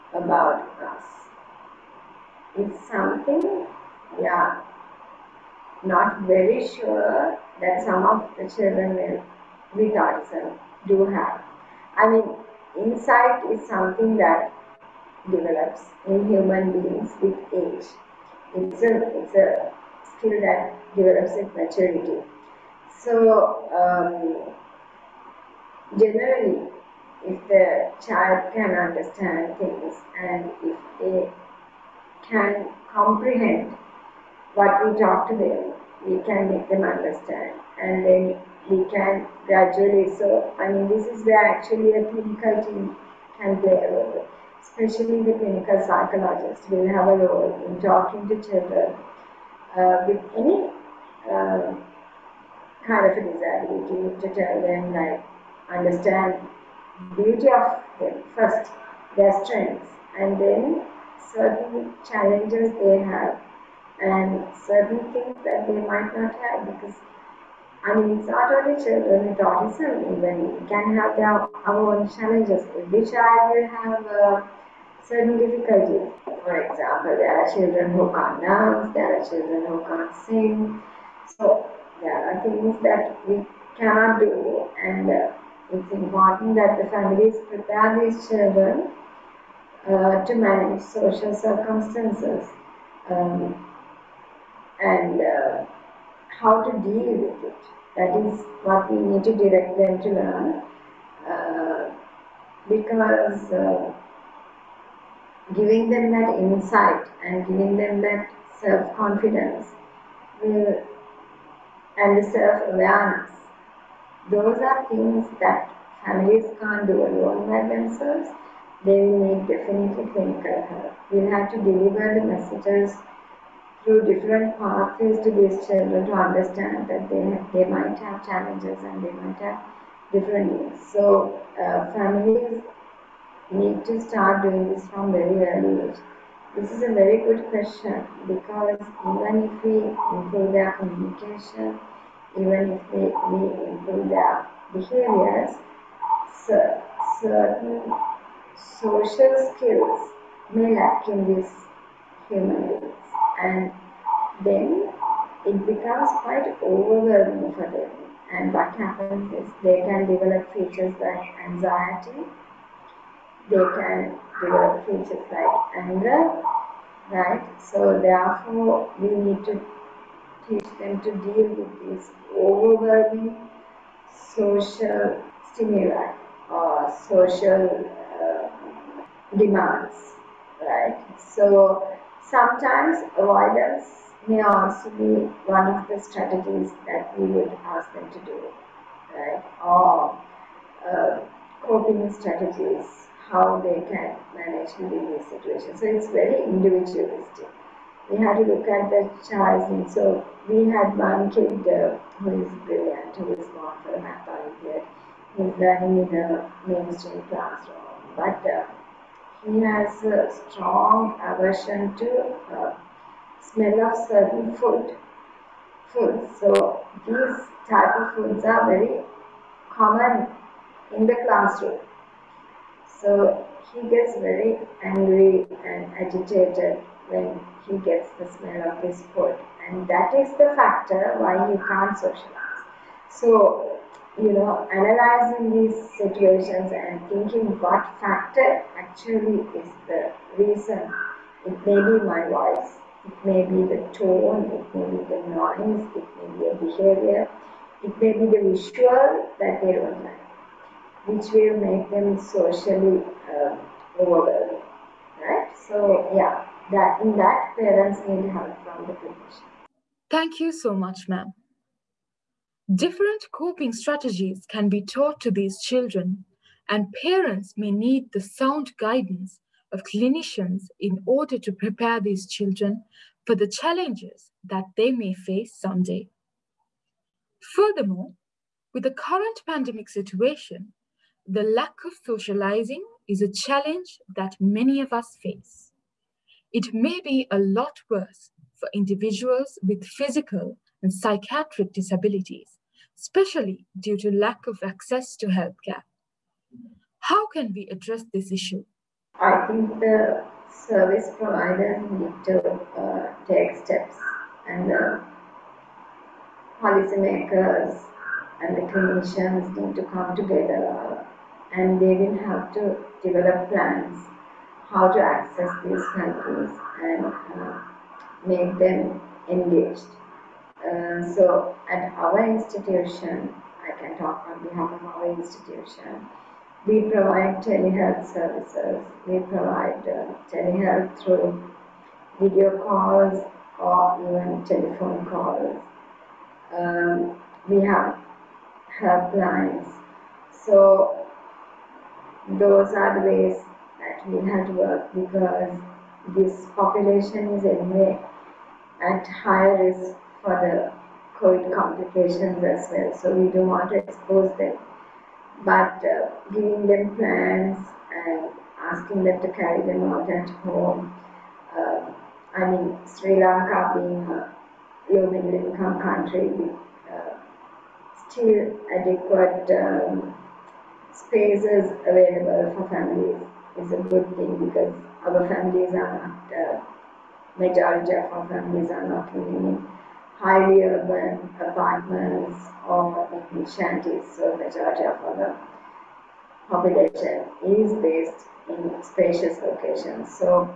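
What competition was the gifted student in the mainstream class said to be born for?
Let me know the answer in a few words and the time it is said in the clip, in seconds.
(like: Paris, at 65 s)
Math olympiad, at 204 s.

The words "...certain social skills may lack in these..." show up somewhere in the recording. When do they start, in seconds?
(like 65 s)
147 s.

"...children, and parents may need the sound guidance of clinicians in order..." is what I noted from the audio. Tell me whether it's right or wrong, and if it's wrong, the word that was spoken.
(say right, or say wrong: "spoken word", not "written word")
right.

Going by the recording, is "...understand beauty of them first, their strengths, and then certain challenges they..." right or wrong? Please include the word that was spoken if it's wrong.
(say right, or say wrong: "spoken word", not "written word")
right.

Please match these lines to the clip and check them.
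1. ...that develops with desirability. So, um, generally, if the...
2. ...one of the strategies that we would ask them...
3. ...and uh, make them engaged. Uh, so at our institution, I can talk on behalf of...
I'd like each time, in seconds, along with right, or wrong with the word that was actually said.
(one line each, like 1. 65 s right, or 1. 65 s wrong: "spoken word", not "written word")
1. 20 s wrong: "maturity", not "desirability"
2. 185 s right
3. 316 s right.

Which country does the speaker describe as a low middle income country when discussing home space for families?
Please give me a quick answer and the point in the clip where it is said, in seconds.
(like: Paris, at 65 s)
Sri Lanka, at 362 s.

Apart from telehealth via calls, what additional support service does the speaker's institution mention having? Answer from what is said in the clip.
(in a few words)
Helplines.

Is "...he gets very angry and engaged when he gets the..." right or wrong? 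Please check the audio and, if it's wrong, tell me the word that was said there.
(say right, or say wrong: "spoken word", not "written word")
wrong: "agitated", not "engaged".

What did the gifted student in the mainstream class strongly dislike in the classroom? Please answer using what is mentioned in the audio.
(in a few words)
Smell of certain food.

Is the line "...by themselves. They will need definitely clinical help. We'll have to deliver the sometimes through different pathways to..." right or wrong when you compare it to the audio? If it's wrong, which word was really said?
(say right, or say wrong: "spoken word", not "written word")
wrong: "messages", not "sometimes".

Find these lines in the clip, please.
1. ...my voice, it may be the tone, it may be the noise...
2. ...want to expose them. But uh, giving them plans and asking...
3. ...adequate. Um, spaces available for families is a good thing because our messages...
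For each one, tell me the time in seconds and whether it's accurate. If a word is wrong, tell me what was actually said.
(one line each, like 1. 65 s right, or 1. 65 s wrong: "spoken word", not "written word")
1. 242 s right
2. 353 s right
3. 368 s wrong: "families", not "messages".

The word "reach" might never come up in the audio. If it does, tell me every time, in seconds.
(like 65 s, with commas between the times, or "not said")
not said.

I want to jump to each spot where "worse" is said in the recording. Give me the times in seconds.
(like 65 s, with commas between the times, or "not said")
287 s.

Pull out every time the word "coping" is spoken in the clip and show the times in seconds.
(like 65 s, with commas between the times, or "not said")
191 s, 263 s.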